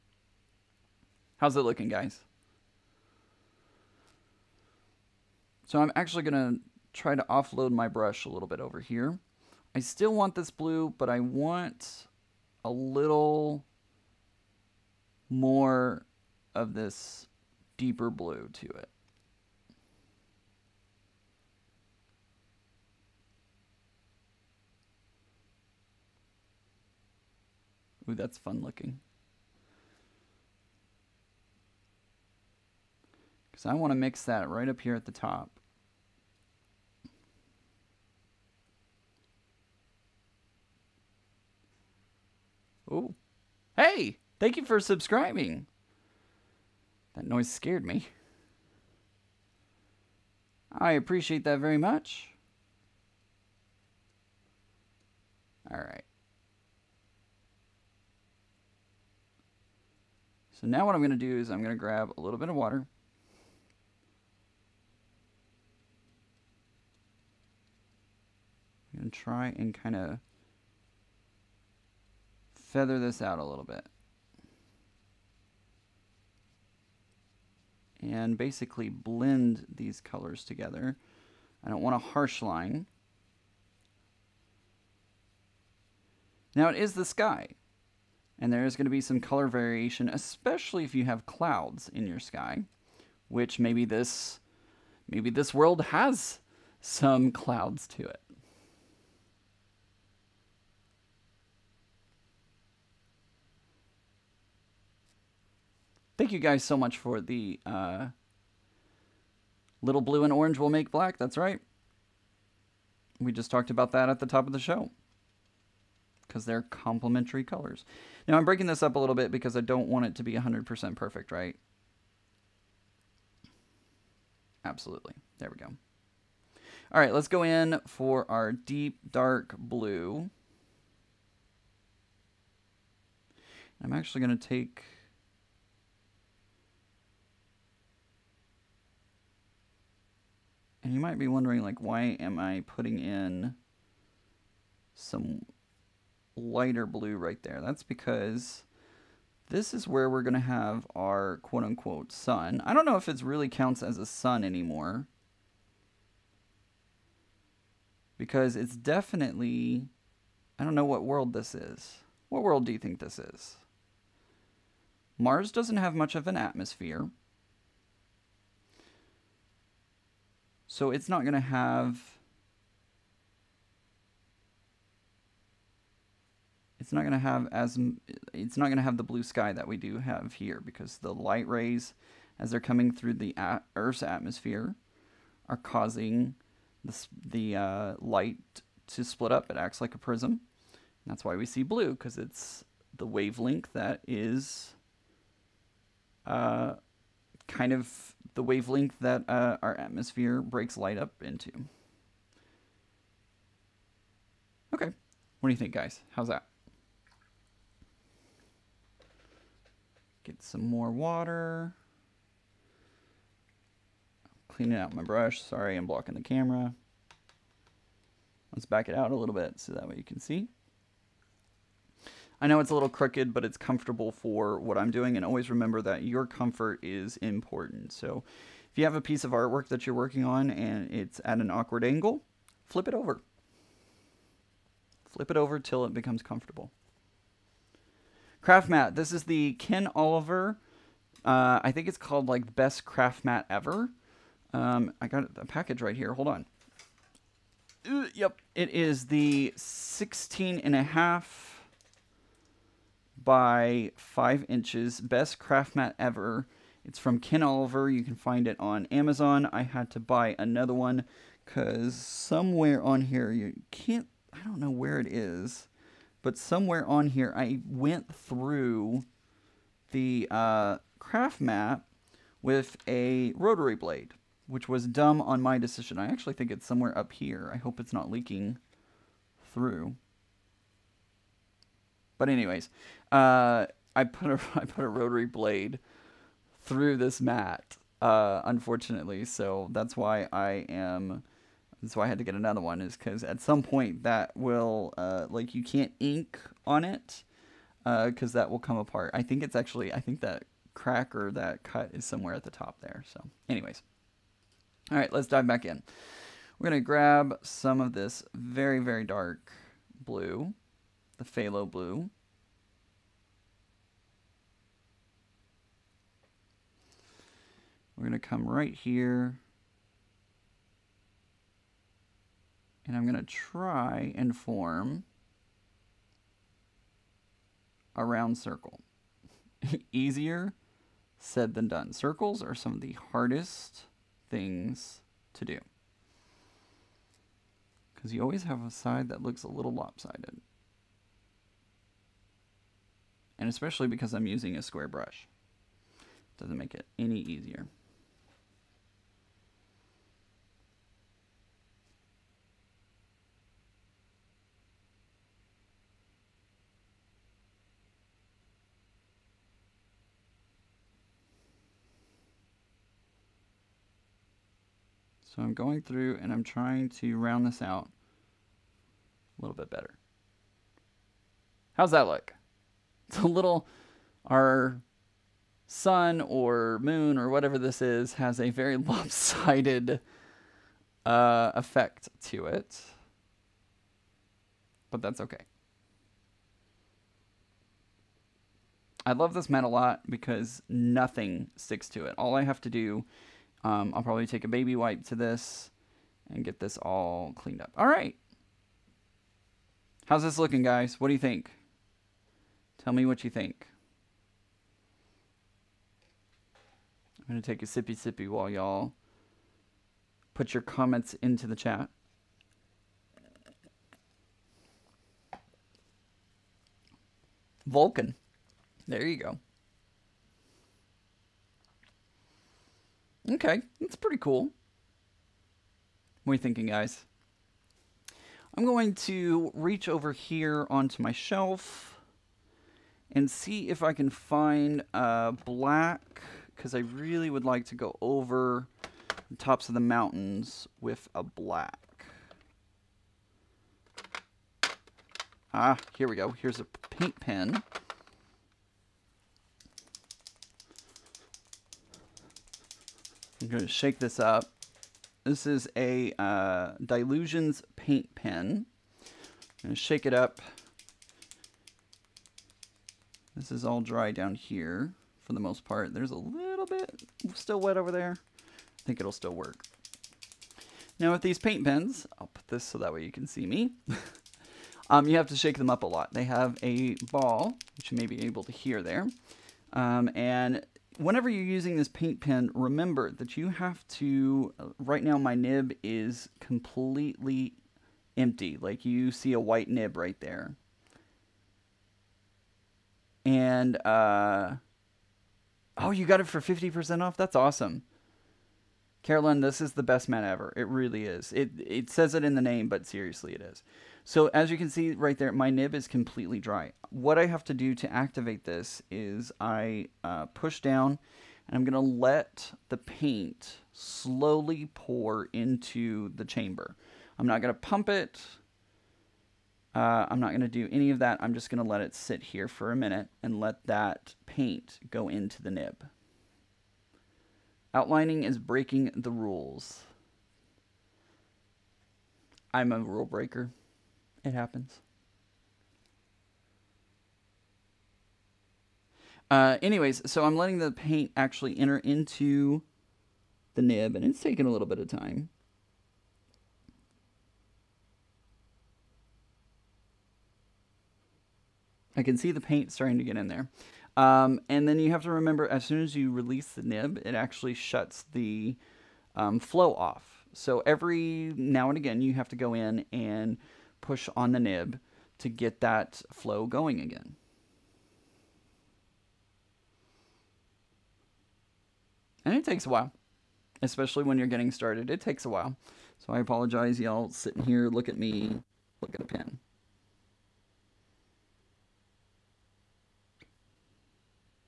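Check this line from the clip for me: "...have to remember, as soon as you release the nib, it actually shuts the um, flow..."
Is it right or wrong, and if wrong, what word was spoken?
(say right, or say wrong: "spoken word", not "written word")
right.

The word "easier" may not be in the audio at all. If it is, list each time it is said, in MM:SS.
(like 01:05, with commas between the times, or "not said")
05:29, 05:47.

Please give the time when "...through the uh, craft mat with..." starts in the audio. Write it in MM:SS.
04:28.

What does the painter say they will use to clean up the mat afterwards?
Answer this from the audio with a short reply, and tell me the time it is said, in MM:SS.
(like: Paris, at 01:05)
a baby wipe, at 06:34.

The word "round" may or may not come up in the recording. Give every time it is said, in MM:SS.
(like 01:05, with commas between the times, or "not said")
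05:28, 06:07.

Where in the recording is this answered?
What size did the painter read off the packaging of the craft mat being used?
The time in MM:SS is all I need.
04:09.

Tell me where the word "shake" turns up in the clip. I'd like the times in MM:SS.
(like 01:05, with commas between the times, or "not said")
07:33, 07:39, 07:55.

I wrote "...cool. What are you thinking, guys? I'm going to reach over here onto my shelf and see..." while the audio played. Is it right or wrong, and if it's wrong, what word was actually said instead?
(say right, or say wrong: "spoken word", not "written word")
right.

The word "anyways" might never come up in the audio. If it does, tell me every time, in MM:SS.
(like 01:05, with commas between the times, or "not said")
04:42, 05:03, 08:59.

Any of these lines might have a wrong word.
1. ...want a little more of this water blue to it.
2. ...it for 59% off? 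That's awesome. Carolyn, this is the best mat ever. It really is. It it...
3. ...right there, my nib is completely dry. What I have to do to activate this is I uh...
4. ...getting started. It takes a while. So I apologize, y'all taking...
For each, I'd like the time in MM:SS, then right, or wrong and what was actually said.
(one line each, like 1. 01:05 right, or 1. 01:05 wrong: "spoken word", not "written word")
1. 00:11 wrong: "deeper", not "water"
2. 08:16 wrong: "50", not "59"
3. 08:24 right
4. 09:34 wrong: "sitting", not "taking".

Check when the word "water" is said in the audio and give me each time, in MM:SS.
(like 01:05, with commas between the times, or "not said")
01:02, 03:30.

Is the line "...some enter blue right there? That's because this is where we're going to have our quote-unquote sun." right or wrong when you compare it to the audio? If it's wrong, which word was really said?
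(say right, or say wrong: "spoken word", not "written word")
wrong: "lighter", not "enter".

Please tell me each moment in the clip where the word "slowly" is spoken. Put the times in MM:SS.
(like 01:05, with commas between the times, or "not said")
08:33.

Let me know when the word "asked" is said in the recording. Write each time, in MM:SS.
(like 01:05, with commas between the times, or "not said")
not said.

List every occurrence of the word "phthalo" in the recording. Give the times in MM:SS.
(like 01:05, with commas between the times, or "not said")
05:11.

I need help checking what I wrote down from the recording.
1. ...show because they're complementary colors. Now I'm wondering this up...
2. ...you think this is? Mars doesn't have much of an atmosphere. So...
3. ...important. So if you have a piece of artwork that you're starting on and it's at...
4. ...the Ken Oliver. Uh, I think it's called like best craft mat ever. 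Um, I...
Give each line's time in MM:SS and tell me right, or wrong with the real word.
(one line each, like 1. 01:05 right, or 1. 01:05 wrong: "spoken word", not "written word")
1. 01:54 wrong: "breaking", not "wondering"
2. 02:42 right
3. 03:47 wrong: "working", not "starting"
4. 03:59 right.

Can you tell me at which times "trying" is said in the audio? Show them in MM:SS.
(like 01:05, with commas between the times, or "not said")
06:06.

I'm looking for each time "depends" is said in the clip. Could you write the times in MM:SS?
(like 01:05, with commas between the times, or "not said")
not said.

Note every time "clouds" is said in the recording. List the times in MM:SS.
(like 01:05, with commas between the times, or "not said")
01:31, 01:37.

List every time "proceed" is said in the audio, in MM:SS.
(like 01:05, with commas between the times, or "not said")
not said.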